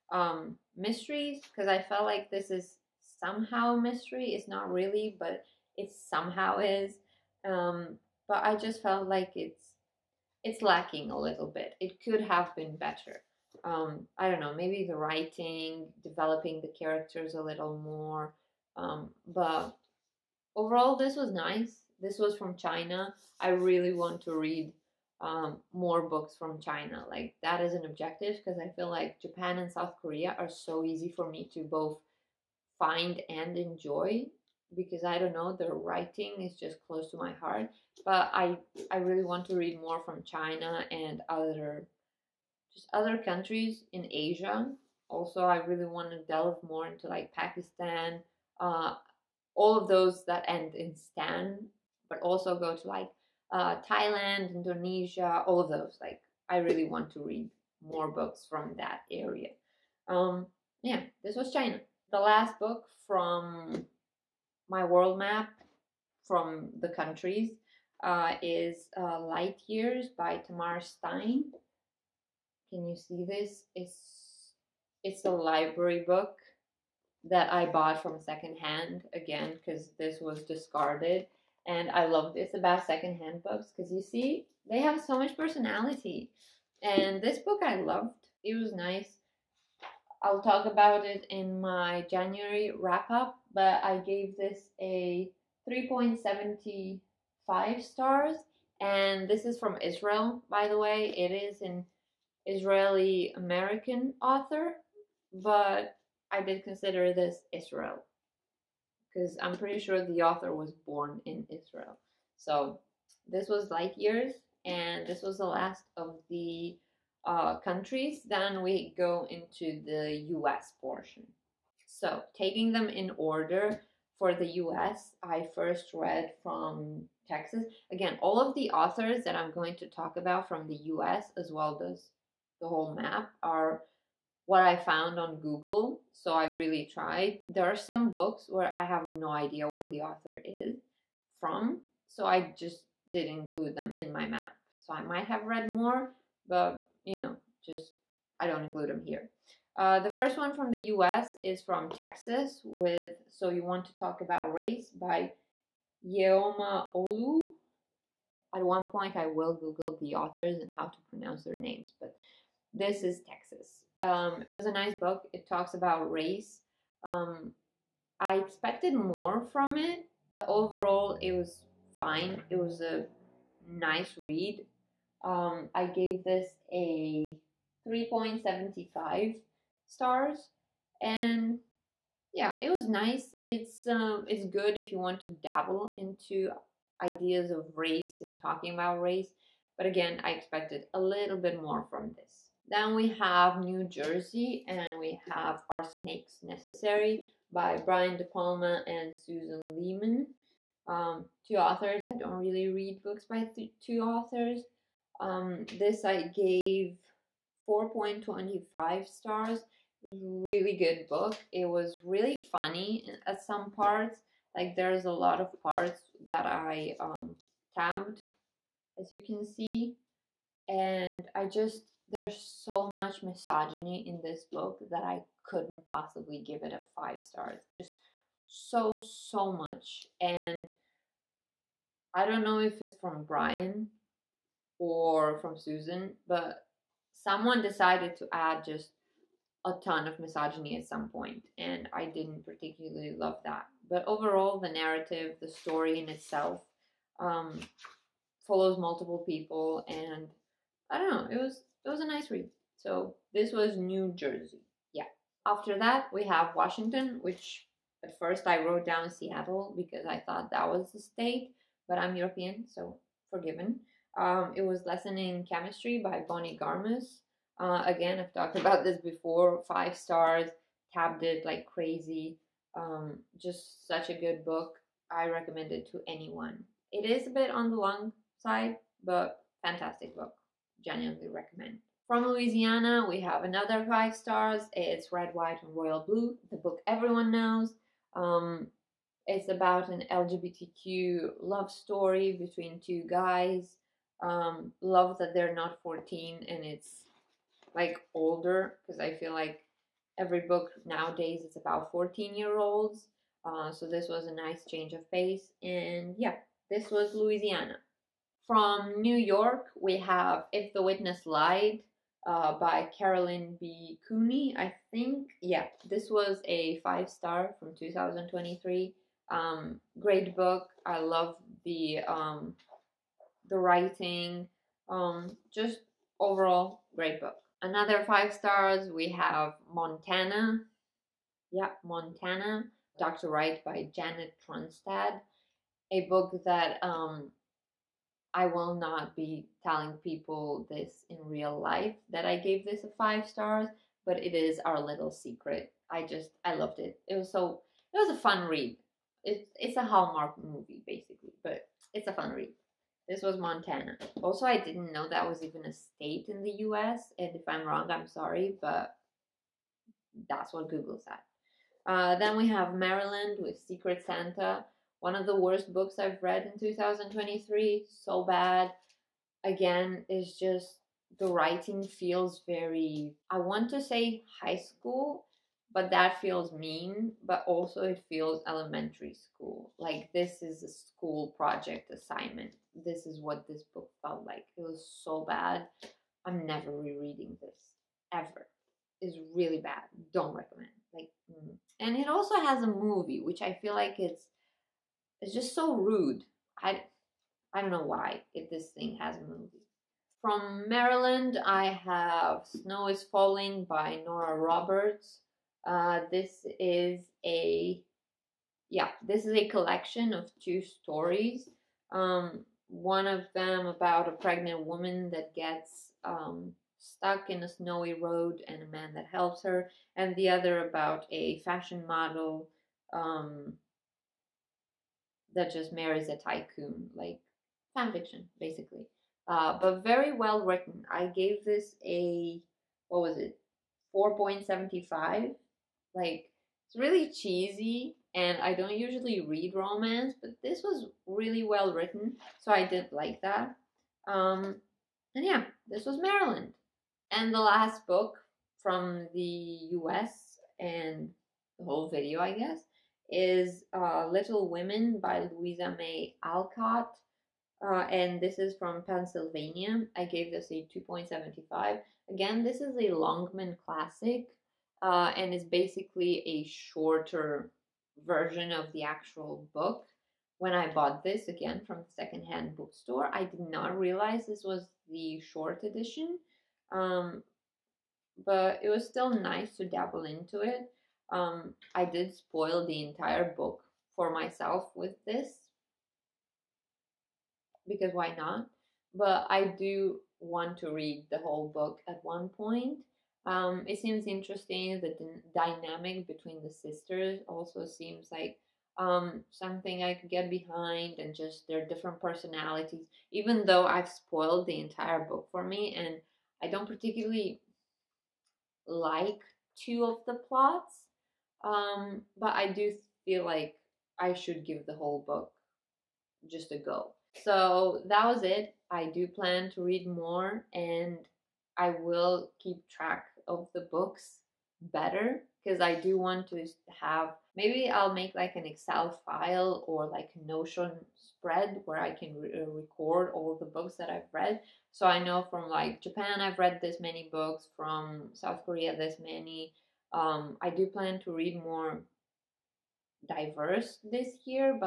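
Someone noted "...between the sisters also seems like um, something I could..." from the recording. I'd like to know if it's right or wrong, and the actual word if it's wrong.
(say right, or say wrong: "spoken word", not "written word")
right.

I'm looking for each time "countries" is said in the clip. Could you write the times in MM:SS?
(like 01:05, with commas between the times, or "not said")
00:43, 01:06, 01:57.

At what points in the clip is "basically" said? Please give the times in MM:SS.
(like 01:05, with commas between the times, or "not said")
05:50, 07:08, 07:45.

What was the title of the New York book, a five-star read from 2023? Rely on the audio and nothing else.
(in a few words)
If the Witness Lied.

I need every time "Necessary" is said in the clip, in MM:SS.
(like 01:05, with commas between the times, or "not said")
03:16.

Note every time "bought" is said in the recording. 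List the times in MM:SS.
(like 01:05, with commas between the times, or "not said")
01:17, 07:50.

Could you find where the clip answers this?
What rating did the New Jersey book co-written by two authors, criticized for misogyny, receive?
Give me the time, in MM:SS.
03:27.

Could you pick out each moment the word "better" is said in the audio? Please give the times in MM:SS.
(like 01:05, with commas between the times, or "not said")
00:12, 08:44.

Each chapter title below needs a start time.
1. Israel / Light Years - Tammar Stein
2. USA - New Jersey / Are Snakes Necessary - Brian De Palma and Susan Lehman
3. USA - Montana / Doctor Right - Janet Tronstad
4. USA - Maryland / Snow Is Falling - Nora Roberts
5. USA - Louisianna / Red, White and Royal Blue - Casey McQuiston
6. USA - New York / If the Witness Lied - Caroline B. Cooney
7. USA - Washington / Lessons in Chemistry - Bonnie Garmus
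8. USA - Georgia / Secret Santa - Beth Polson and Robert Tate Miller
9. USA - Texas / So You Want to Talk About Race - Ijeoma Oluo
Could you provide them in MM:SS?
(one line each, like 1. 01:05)
1. 01:02
2. 03:12
3. 05:26
4. 06:39
5. 04:41
6. 05:07
7. 04:15
8. 06:01
9. 02:29.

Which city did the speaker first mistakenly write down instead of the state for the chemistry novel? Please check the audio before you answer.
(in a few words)
Seattle.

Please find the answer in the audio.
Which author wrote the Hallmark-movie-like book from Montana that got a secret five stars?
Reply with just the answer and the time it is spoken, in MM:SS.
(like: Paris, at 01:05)
Janet Tronstad, at 05:33.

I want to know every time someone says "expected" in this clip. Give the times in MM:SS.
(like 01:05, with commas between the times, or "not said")
02:48, 03:10.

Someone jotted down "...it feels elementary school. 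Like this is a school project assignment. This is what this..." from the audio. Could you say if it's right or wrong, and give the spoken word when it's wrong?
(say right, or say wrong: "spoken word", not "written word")
right.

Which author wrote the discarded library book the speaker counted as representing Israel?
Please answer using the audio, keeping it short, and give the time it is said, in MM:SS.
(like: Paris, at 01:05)
Tammar Stein, at 01:10.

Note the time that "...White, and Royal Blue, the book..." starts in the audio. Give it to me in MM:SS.
04:45.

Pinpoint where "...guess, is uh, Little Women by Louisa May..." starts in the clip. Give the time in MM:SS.
07:32.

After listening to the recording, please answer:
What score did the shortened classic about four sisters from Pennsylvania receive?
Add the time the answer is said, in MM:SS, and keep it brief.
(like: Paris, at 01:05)
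2.75, at 07:40.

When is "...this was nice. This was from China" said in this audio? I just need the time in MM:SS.
00:20.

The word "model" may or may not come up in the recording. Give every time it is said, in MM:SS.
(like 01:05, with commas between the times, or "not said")
07:01.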